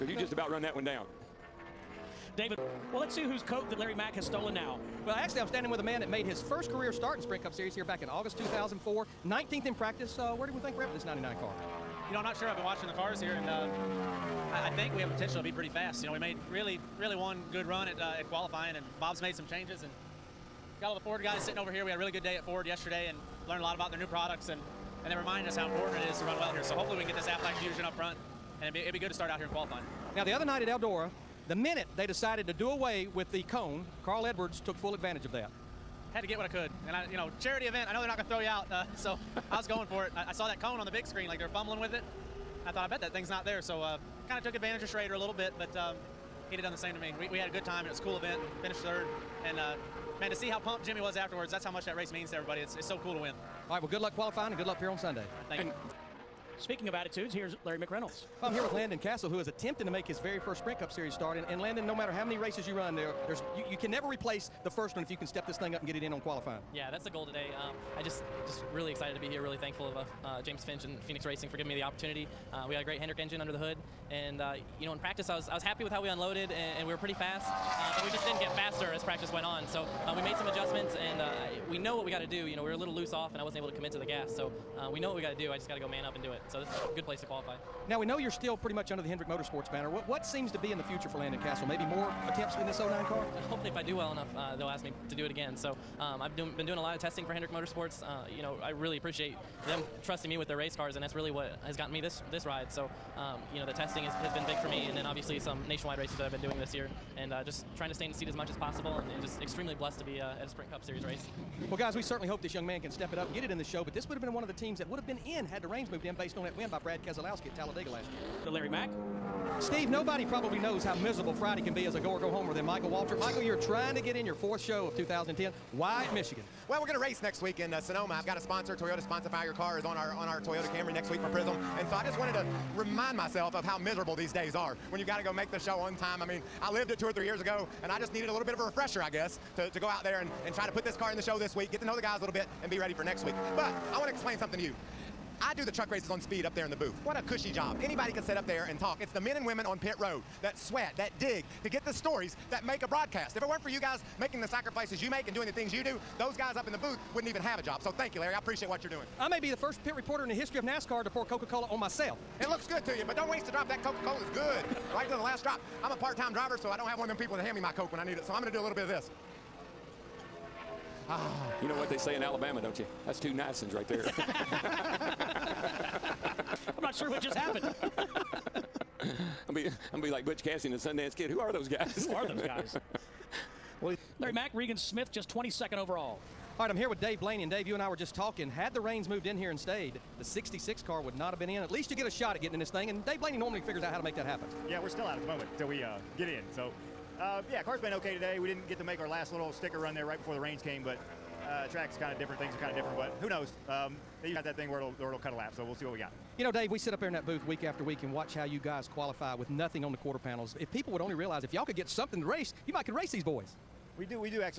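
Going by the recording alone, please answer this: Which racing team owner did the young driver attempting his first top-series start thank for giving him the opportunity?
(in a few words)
James Finch.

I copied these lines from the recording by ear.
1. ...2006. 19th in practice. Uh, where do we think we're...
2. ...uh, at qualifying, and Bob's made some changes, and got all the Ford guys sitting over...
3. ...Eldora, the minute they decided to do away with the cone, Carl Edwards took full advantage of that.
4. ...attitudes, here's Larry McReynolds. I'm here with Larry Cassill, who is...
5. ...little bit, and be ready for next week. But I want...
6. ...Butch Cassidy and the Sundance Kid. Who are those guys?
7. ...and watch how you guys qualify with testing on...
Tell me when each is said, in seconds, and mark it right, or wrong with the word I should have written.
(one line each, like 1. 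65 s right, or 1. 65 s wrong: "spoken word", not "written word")
1. 8 s wrong: "2004", not "2006"
2. 17 s right
3. 30 s right
4. 56 s wrong: "Landon", not "Larry"
5. 142 s right
6. 180 s right
7. 208 s wrong: "nothing", not "testing".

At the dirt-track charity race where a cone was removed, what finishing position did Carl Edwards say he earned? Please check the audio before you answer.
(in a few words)
third.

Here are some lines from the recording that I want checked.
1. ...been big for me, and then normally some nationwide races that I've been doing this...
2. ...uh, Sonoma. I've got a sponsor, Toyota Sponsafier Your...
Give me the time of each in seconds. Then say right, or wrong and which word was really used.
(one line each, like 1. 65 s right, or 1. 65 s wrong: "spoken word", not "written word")
1. 104 s wrong: "obviously", not "normally"
2. 127 s right.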